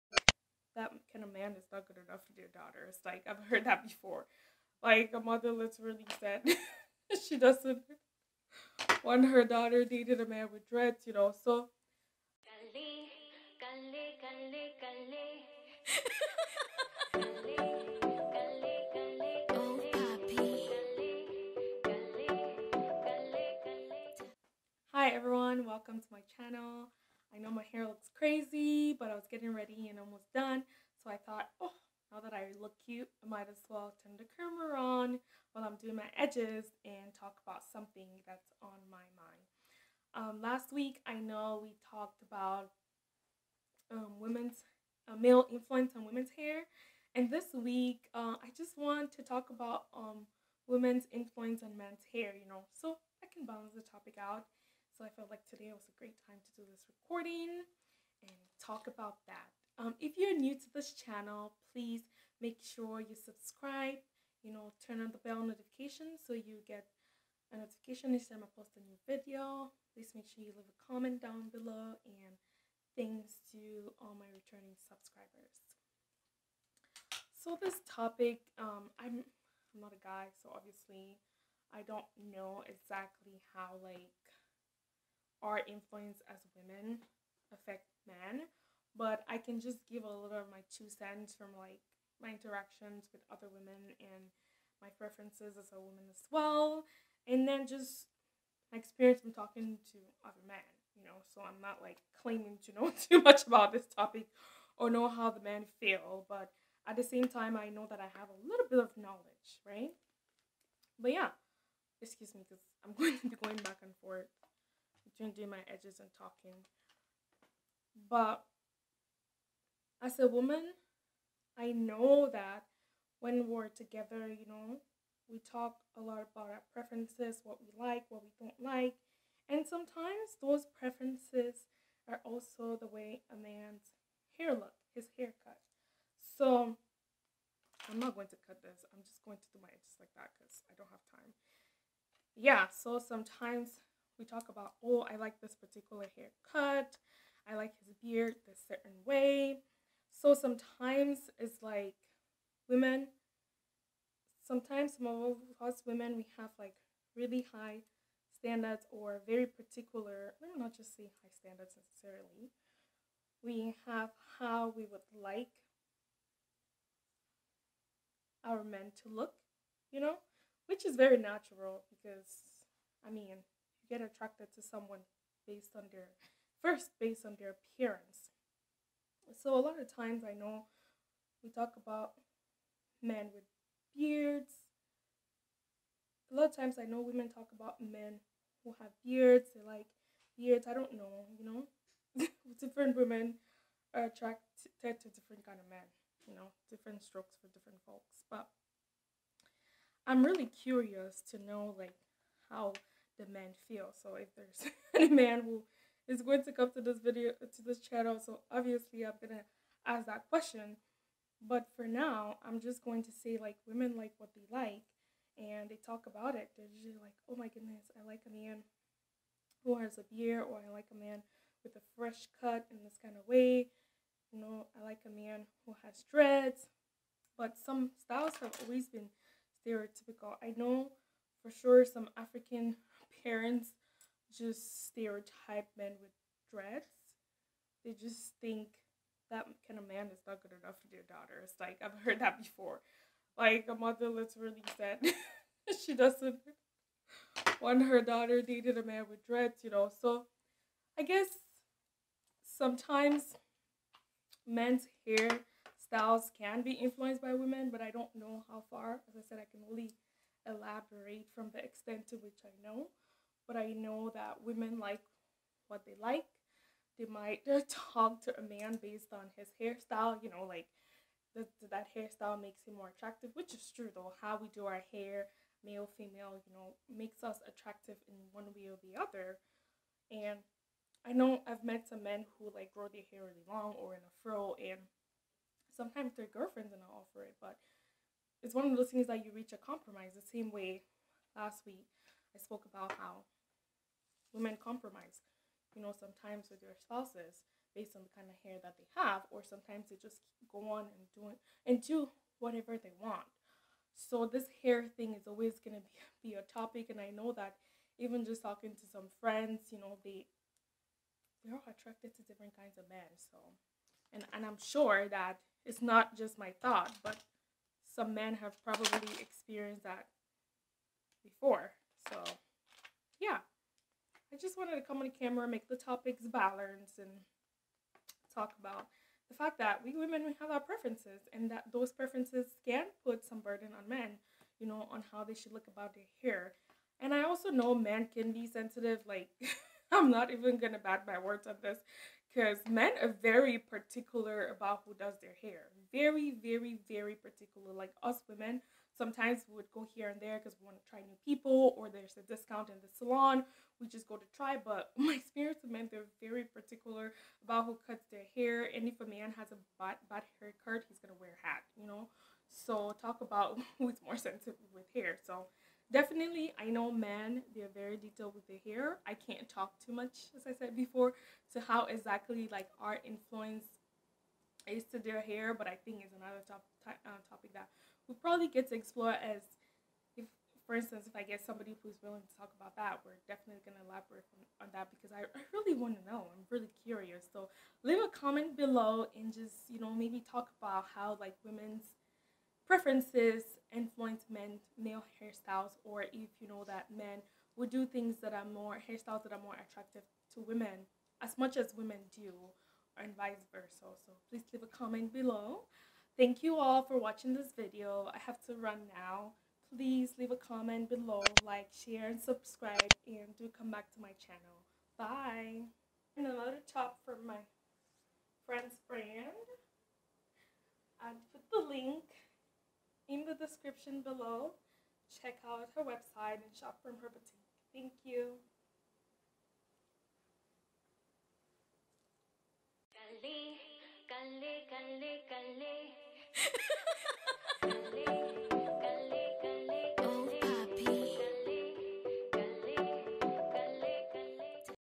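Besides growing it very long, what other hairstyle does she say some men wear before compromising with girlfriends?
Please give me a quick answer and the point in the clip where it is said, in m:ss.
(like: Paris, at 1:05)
a fro, at 4:43.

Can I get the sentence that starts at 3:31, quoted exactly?
But for now, I'm just going to say like women like what they like and they talk about it.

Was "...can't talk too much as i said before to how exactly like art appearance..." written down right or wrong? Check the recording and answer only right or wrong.
wrong.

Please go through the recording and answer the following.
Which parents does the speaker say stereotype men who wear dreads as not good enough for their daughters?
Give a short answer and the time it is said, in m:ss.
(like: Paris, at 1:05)
African parents, at 3:52.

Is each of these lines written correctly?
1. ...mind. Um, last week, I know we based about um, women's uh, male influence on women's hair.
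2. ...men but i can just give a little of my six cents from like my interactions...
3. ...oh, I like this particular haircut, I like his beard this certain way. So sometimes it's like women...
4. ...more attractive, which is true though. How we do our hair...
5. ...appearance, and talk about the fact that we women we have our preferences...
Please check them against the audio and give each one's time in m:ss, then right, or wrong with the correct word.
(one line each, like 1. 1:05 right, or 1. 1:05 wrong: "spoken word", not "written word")
1. 0:39 wrong: "talked", not "based"
2. 1:28 wrong: "two", not "six"
3. 2:24 right
4. 4:32 right
5. 5:26 wrong: "balance", not "appearance".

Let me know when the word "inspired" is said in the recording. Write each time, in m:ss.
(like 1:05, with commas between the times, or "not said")
not said.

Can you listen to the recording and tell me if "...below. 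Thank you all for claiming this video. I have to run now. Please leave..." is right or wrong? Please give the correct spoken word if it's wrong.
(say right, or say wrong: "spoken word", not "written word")
wrong: "watching", not "claiming".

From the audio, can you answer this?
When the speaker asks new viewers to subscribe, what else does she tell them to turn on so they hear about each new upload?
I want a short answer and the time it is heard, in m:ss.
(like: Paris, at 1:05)
bell notification, at 1:05.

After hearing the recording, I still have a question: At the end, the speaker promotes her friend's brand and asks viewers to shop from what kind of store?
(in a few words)
boutique.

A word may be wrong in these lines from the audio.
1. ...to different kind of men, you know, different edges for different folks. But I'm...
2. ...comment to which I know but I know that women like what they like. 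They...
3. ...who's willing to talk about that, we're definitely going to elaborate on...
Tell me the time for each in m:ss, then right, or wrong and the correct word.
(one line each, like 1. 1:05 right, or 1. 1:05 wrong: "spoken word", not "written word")
1. 3:14 wrong: "strokes", not "edges"
2. 4:21 wrong: "extent", not "comment"
3. 6:21 right.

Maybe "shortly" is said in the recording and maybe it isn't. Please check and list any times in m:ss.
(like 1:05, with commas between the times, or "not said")
not said.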